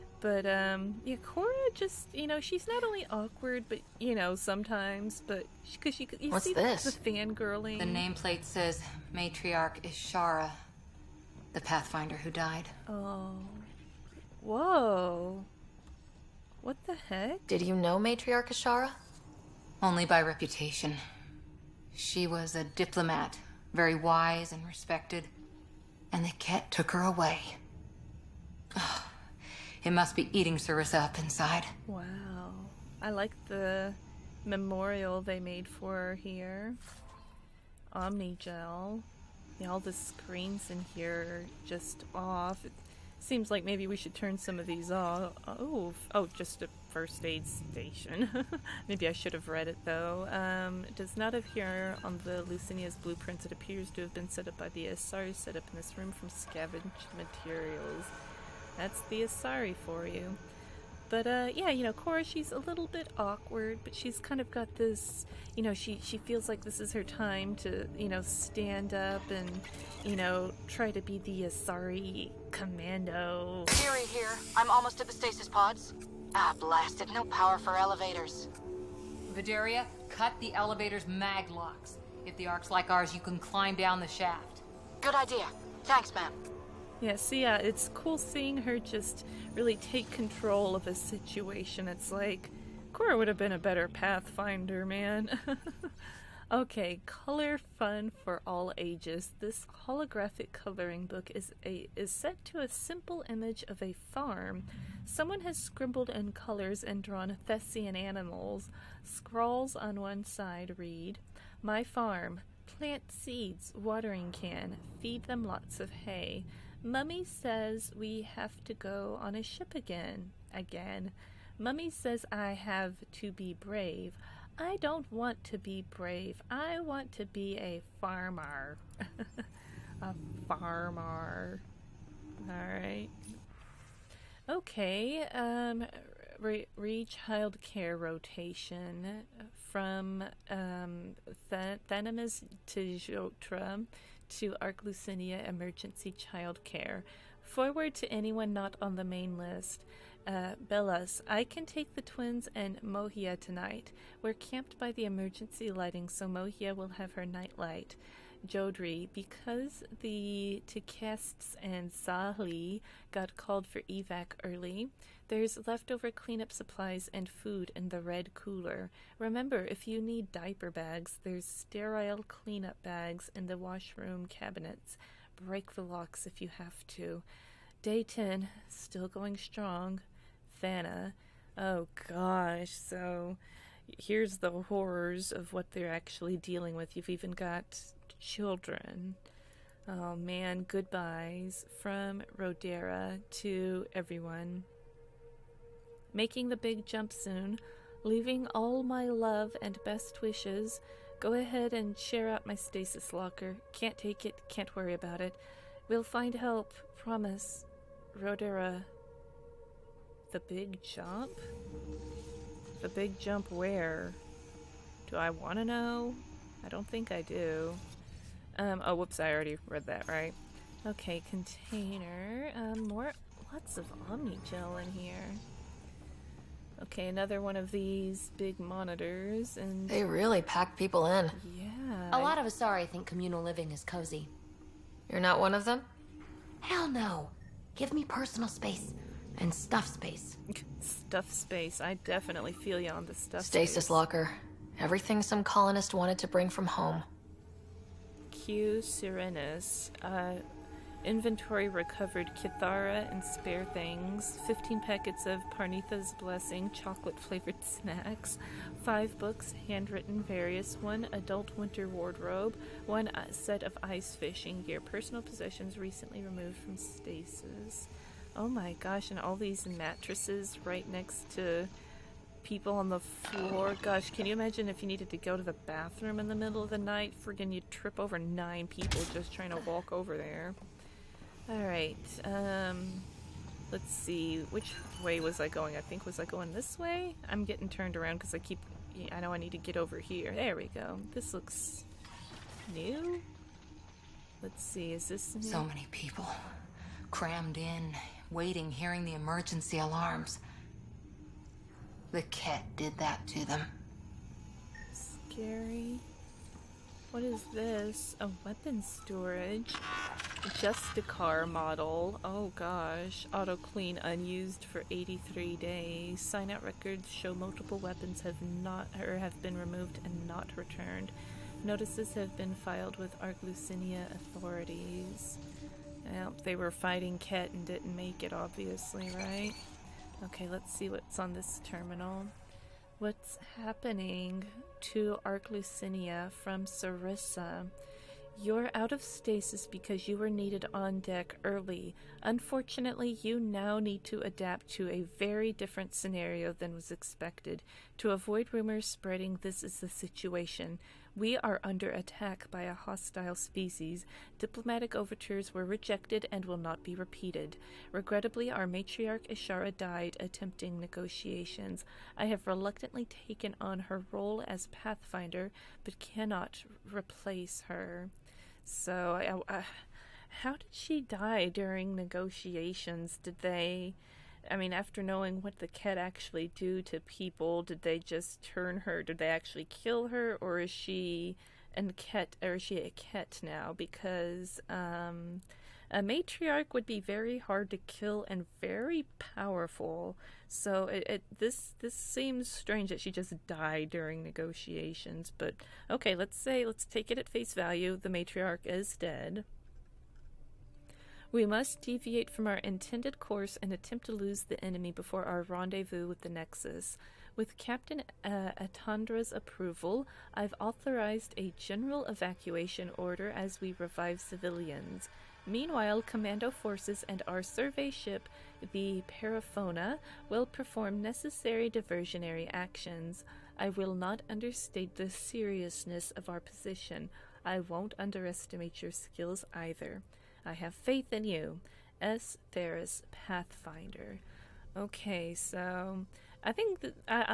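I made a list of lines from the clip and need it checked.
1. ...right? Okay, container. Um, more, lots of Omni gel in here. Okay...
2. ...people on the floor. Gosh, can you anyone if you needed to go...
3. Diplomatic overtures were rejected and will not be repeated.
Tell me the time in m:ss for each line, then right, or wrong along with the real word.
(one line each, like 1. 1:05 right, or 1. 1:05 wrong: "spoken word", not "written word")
1. 3:40 right
2. 4:32 wrong: "imagine", not "anyone"
3. 5:54 right.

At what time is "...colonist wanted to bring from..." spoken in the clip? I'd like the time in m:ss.
4:05.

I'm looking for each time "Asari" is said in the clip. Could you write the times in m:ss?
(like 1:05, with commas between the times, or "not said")
0:54, 0:59, 1:11, 3:52.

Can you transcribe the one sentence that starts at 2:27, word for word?
Forward to anyone not on the main list.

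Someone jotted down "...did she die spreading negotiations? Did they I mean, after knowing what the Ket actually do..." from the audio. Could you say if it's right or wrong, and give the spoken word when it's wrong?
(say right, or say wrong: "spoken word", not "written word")
wrong: "during", not "spreading".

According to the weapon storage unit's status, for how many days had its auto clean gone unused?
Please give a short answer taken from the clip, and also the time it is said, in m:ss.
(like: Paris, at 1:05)
83, at 5:14.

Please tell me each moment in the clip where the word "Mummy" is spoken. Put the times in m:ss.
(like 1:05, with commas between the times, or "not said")
1:56, 2:01.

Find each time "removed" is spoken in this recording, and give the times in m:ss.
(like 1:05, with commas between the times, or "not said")
4:26, 5:19.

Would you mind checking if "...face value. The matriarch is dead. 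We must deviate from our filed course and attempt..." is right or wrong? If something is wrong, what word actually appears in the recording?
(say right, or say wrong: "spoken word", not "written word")
wrong: "intended", not "filed".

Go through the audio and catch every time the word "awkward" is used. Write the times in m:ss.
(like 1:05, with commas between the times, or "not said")
0:03, 1:03.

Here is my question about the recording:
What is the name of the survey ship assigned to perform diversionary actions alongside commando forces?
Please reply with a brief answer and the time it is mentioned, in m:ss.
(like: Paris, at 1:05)
Paraphona, at 6:59.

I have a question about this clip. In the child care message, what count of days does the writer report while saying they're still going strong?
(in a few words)
10.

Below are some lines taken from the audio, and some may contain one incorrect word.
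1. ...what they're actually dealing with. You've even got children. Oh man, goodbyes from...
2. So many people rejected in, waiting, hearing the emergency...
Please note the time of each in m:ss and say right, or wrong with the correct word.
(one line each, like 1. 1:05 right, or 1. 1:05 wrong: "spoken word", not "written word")
1. 3:05 right
2. 4:55 wrong: "crammed", not "rejected".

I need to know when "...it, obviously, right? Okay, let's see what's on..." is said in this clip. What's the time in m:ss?
5:28.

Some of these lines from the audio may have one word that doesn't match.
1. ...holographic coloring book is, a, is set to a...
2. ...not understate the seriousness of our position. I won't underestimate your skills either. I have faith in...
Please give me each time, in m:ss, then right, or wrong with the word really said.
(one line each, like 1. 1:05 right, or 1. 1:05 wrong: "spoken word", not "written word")
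1. 1:39 right
2. 7:03 right.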